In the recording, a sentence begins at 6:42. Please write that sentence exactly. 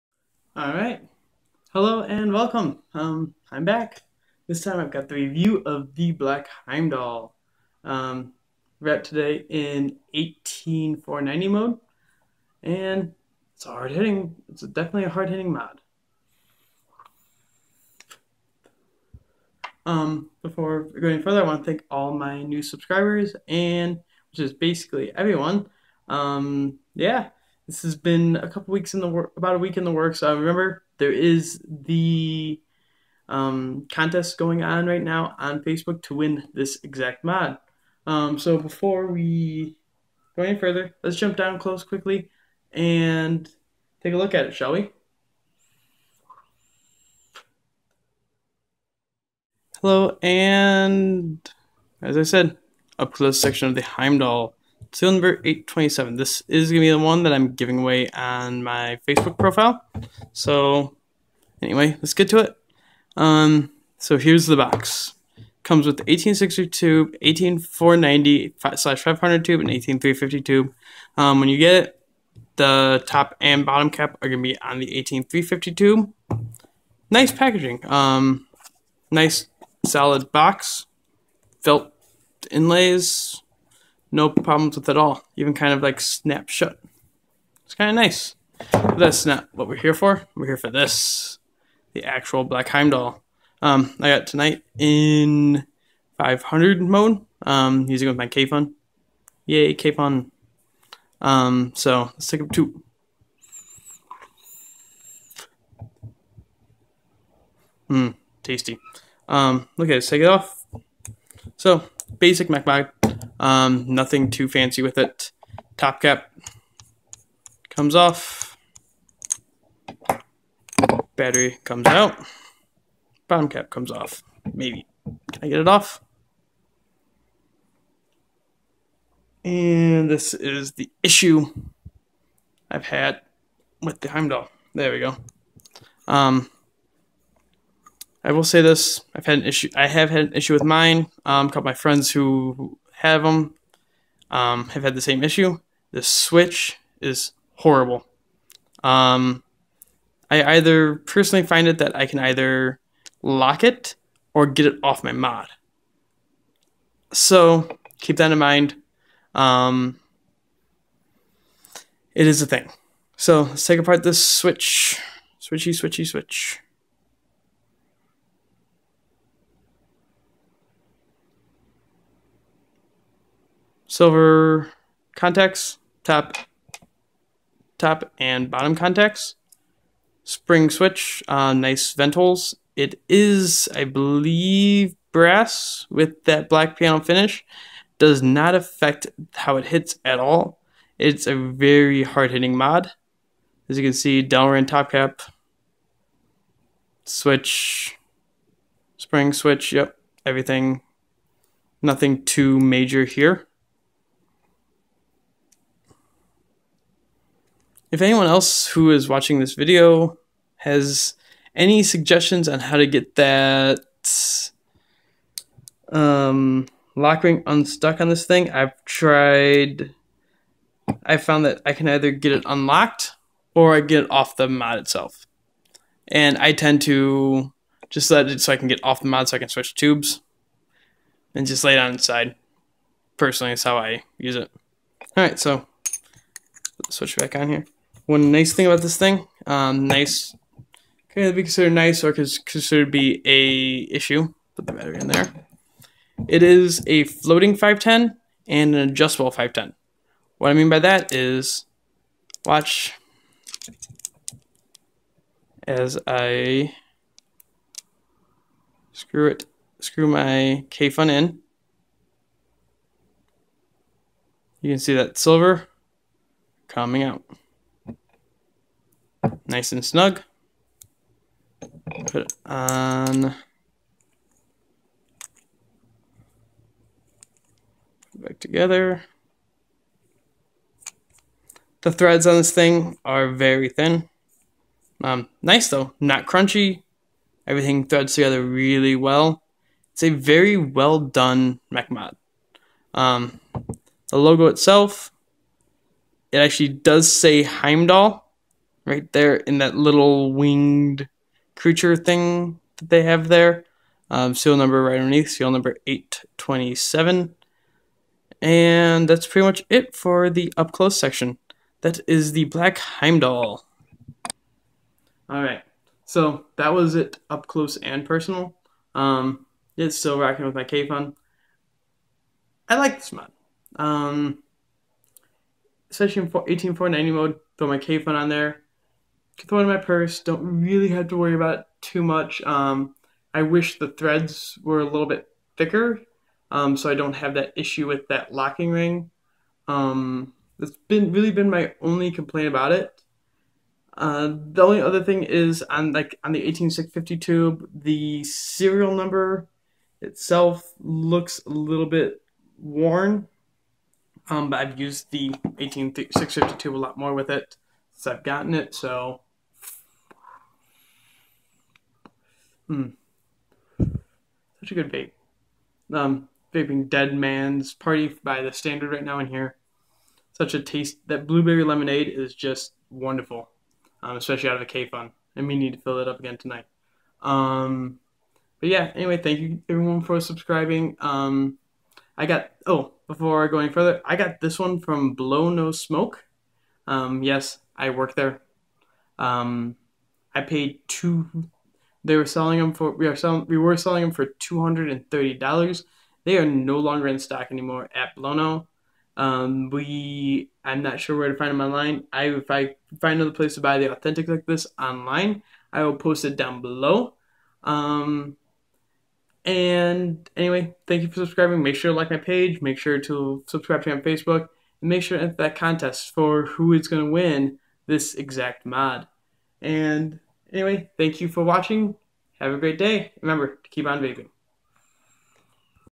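I if I find another place to buy the authentic like this online, I will post it down below.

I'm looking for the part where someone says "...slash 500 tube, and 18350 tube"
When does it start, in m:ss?
1:08.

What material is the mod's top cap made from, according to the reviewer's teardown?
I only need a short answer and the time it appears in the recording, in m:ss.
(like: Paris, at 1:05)
Delrin, at 3:14.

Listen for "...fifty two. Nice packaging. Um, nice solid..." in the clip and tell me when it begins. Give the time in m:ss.
1:15.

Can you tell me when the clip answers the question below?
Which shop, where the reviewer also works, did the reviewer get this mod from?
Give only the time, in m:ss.
6:25.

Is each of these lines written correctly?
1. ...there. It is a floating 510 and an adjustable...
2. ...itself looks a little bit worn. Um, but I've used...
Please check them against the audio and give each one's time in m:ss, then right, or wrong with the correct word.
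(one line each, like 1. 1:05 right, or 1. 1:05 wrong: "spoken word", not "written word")
1. 4:05 right
2. 5:50 right.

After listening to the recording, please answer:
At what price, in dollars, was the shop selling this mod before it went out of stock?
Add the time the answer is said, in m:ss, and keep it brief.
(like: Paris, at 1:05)
$230, at 6:34.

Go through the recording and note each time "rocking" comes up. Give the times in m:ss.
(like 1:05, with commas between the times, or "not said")
5:20.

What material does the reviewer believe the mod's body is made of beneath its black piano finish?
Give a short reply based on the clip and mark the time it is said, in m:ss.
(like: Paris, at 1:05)
Brass, at 3:05.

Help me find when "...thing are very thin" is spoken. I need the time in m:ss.
4:42.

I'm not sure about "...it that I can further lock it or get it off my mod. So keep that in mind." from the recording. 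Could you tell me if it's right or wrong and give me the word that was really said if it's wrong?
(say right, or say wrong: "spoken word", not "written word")
wrong: "either", not "further".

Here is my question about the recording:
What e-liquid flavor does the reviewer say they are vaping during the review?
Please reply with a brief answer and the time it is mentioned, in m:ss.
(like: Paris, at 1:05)
Dead Man's Party, at 6:06.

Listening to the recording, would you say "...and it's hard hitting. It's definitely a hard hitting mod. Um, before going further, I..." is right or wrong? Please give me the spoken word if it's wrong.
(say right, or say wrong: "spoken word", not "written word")
right.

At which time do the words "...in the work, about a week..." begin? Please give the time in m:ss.
0:28.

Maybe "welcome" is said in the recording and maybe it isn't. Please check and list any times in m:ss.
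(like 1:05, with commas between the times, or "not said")
0:02.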